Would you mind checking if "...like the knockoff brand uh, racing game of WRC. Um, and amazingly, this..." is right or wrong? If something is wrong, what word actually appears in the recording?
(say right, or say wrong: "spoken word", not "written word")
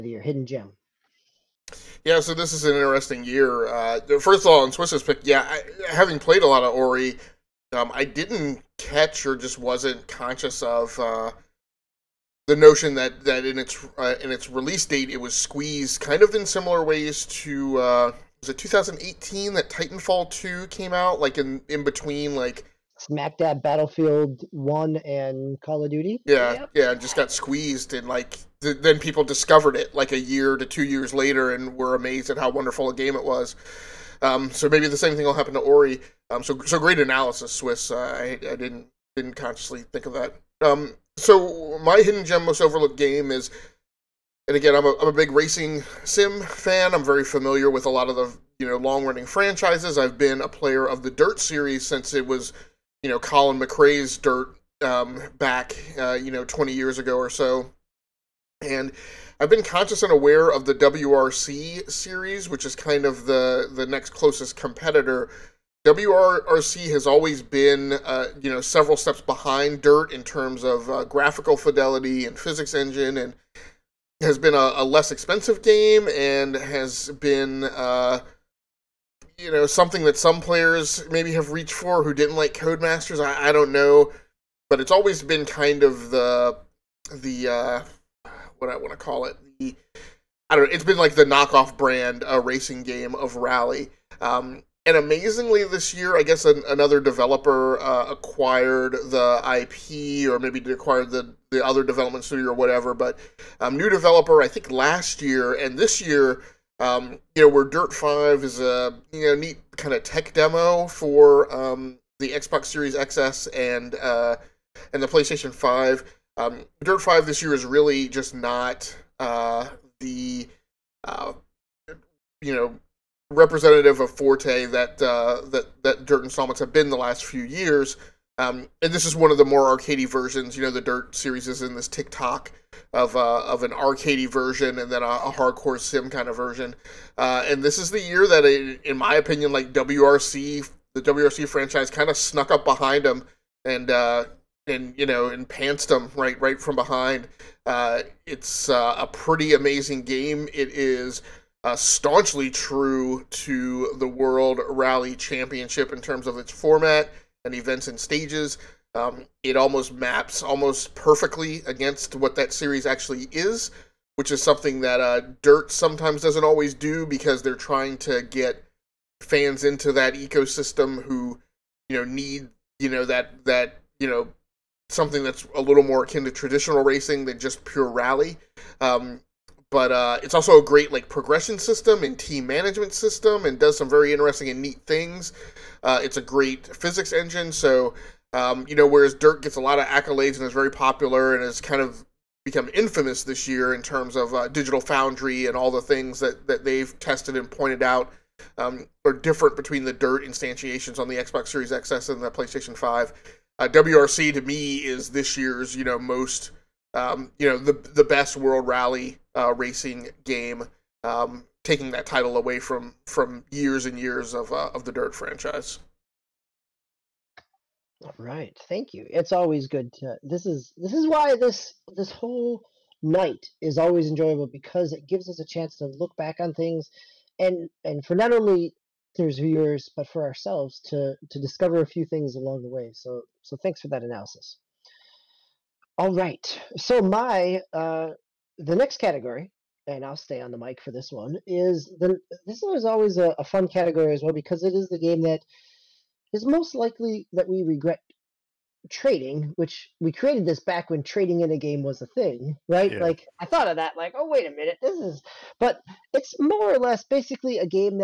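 wrong: "Rally", not "WRC".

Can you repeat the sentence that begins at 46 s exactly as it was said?
I'm very familiar with a lot of the you know long running franchises.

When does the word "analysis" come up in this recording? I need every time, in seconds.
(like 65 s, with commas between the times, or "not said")
36 s, 234 s.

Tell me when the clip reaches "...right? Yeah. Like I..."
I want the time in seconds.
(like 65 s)
252 s.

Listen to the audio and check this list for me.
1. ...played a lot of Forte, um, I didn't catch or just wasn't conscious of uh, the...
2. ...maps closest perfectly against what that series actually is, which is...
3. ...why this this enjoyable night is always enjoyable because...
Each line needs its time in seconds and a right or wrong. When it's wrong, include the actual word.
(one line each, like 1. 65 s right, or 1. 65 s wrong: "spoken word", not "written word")
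1. 6 s wrong: "Ori", not "Forte"
2. 159 s wrong: "almost", not "closest"
3. 221 s wrong: "whole", not "enjoyable".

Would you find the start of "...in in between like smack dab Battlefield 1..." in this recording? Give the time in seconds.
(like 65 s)
21 s.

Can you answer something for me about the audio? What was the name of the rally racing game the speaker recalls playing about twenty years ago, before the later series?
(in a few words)
Colin McRae's Dirt.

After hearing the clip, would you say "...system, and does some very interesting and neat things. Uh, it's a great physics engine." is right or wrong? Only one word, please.
right.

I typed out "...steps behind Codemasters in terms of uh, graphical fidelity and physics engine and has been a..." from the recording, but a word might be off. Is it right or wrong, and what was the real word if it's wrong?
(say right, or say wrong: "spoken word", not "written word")
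wrong: "Dirt", not "Codemasters".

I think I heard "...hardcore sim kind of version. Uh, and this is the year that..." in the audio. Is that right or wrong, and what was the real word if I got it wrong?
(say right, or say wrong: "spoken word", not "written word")
right.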